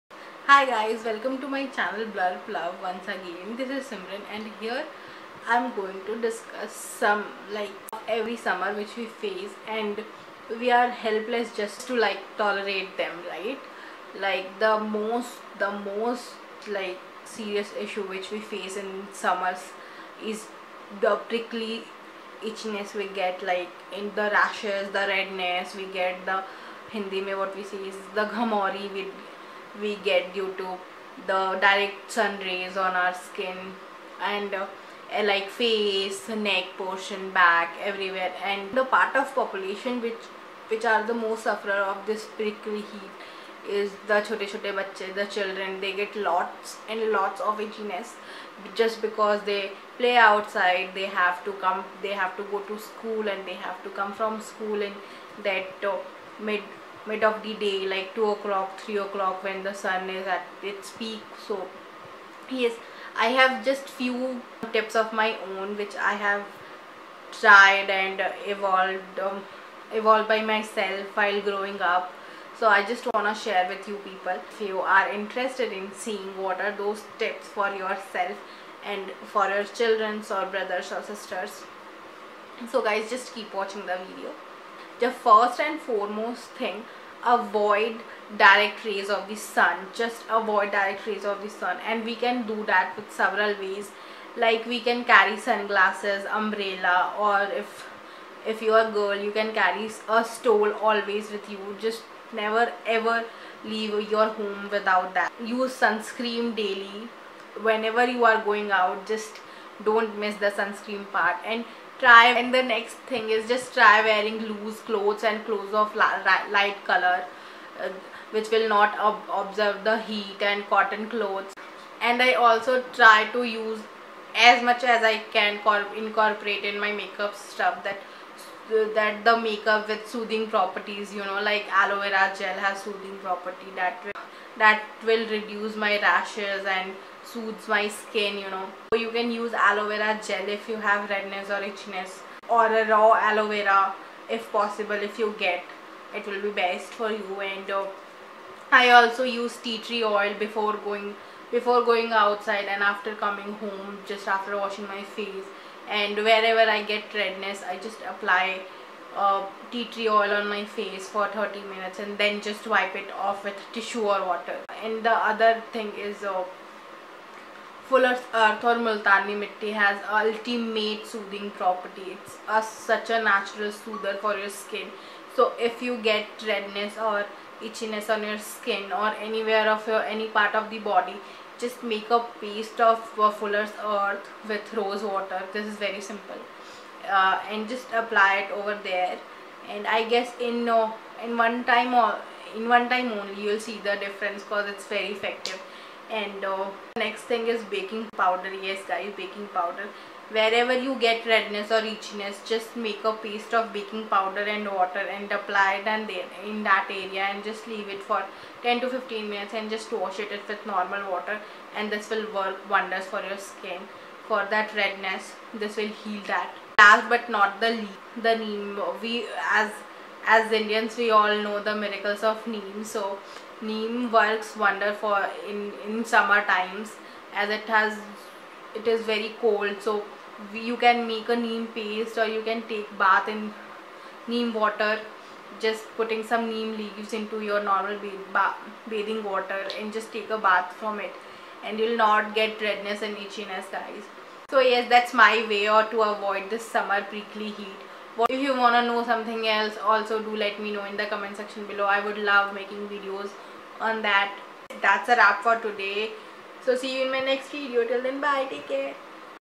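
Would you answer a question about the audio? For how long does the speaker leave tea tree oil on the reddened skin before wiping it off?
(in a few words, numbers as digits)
30 minutes.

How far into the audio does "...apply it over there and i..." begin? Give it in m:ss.
3:08.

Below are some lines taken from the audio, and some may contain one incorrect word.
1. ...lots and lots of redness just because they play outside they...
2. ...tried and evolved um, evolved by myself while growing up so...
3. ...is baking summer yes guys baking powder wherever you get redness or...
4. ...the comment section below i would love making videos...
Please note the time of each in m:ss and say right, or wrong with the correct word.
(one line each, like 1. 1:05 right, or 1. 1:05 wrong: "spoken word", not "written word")
1. 0:46 wrong: "itchiness", not "redness"
2. 1:07 right
3. 3:17 wrong: "powder", not "summer"
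4. 4:10 right.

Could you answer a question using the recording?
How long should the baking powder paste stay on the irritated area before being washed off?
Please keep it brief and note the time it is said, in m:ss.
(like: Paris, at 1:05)
10 to 15 minutes, at 3:28.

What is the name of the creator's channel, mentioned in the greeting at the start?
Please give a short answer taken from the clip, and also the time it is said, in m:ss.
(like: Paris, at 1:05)
Bllurp Love, at 0:02.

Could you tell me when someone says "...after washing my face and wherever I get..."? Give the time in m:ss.
2:34.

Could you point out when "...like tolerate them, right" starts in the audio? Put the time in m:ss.
0:11.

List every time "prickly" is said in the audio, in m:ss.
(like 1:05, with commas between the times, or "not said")
0:21, 0:42, 4:07.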